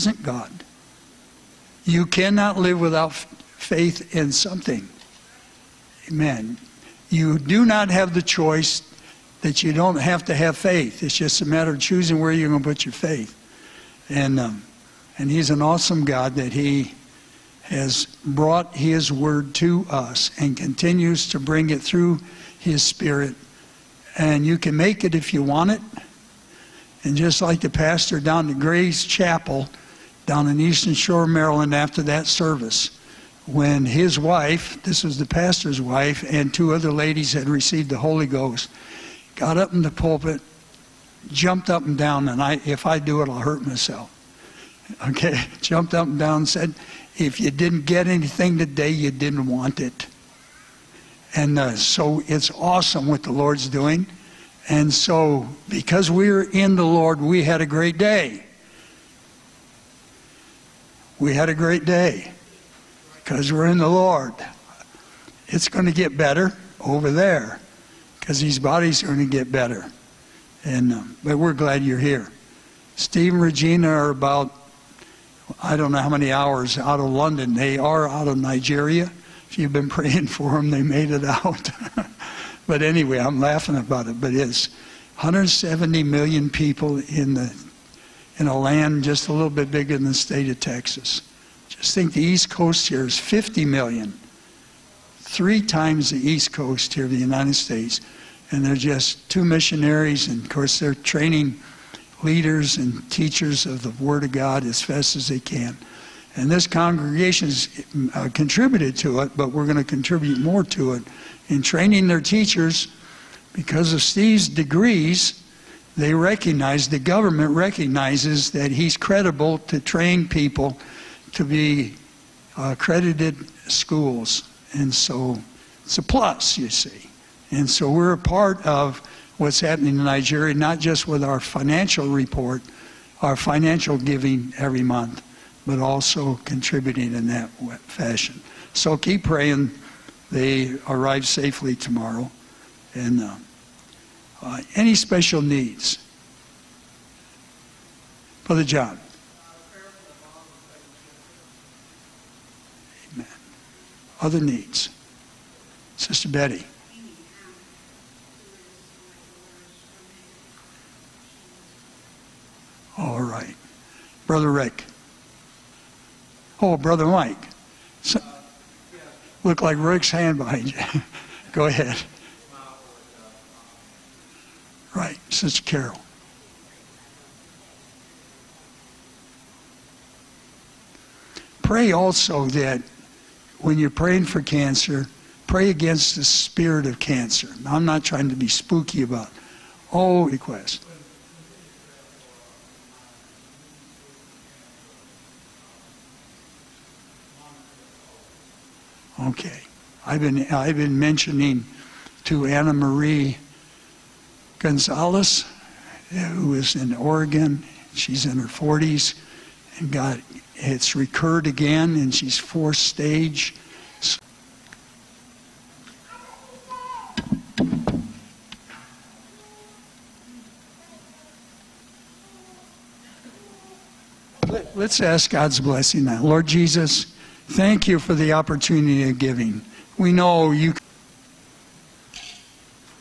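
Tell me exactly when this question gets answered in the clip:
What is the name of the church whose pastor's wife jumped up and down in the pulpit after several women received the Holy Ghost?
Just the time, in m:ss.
0:28.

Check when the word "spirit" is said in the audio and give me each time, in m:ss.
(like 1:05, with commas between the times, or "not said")
0:22, 3:06.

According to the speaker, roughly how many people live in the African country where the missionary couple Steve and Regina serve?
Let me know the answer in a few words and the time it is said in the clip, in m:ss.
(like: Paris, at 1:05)
170 million, at 1:25.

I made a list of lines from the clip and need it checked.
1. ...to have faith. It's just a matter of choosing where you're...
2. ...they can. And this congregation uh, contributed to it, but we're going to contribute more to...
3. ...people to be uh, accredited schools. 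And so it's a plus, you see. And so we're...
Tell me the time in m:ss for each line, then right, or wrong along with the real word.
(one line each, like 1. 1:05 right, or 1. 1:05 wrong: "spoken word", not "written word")
1. 0:10 right
2. 1:45 right
3. 2:00 right.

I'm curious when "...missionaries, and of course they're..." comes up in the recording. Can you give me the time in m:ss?
1:39.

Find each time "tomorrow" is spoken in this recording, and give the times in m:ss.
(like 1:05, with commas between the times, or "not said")
2:21.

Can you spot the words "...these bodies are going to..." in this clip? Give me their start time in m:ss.
1:08.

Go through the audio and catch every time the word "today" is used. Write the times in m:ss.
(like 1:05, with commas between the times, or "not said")
0:48.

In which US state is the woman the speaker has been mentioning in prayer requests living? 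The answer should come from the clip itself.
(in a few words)
Oregon.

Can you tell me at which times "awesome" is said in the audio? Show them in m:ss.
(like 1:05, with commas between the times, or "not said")
0:15, 0:52.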